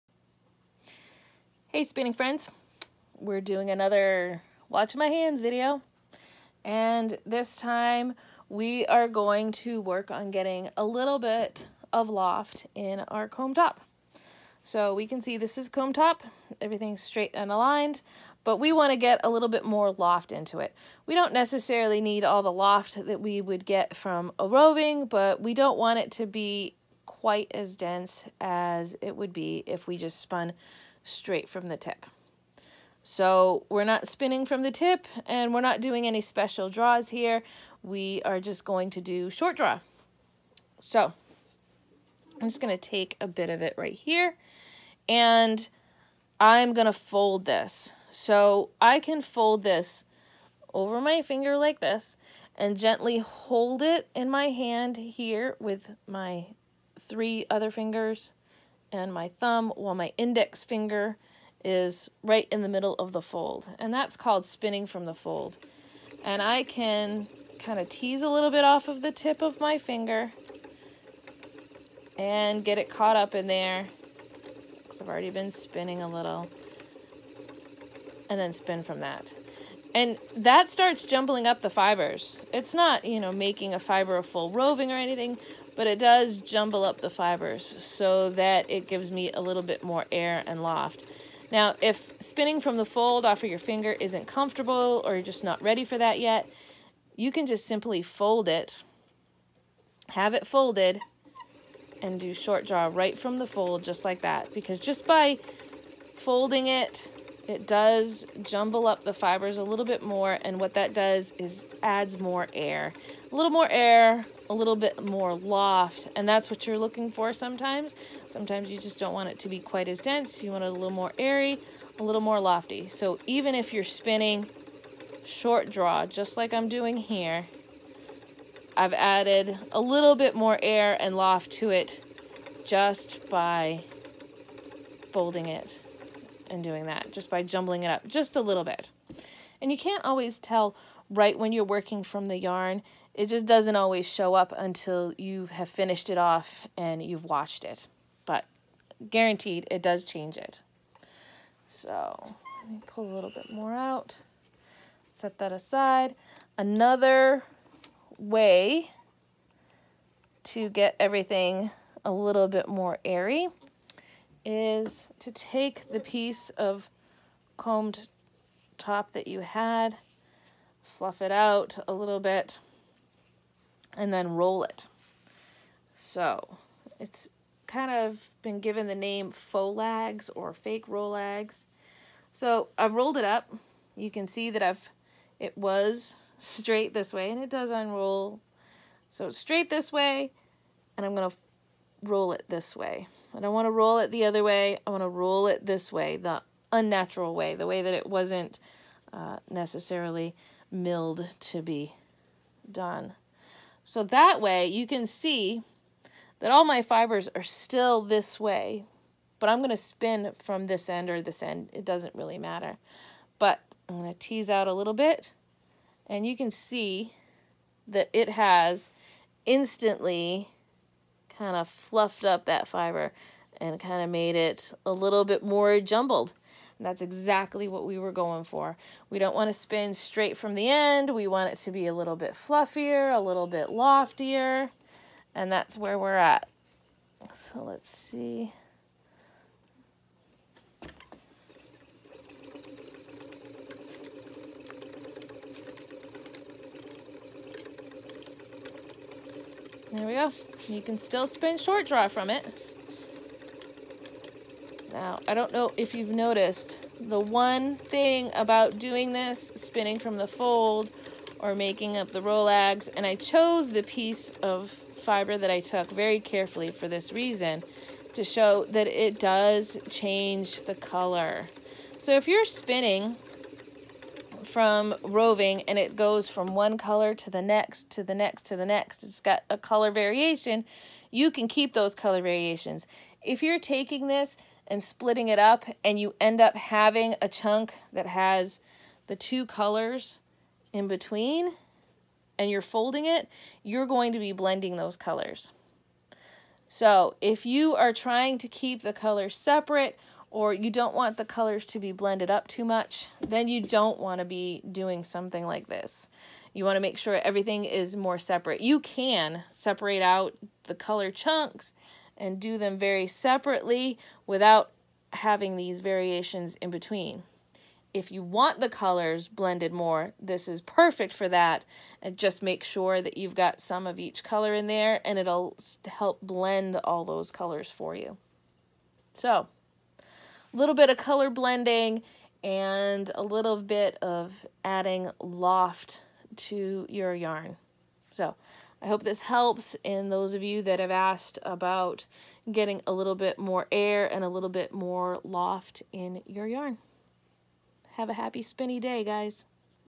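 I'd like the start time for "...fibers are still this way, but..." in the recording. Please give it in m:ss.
3:26.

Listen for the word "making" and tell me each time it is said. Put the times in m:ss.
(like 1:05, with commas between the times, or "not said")
1:23, 4:21.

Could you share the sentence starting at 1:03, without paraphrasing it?
And that's called spinning from the fold.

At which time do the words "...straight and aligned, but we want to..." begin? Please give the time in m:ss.
0:17.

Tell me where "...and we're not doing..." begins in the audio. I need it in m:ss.
0:35.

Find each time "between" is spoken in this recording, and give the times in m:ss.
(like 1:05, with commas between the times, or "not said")
4:50, 5:16.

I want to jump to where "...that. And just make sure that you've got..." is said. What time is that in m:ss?
5:21.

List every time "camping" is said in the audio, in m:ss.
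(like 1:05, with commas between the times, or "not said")
not said.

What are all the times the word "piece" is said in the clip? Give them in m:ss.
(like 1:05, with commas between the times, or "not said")
2:45, 4:23.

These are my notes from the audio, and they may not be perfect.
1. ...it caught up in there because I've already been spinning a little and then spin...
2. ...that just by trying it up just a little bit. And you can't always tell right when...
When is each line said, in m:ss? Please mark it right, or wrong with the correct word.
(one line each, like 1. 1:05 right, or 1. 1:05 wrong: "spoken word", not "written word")
1. 1:12 right
2. 2:16 wrong: "jumbling", not "trying".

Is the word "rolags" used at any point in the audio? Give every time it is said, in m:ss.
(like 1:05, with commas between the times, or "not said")
3:00, 4:22.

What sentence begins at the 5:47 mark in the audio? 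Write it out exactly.
Have a happy spinny day, guys.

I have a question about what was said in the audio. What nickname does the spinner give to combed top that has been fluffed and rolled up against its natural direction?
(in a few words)
faux lags.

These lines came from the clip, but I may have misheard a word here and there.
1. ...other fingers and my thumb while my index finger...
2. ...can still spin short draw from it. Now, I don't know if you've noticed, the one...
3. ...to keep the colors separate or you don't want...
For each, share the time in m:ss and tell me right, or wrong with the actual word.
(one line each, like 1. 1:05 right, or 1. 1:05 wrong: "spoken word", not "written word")
1. 0:57 right
2. 4:10 right
3. 4:58 right.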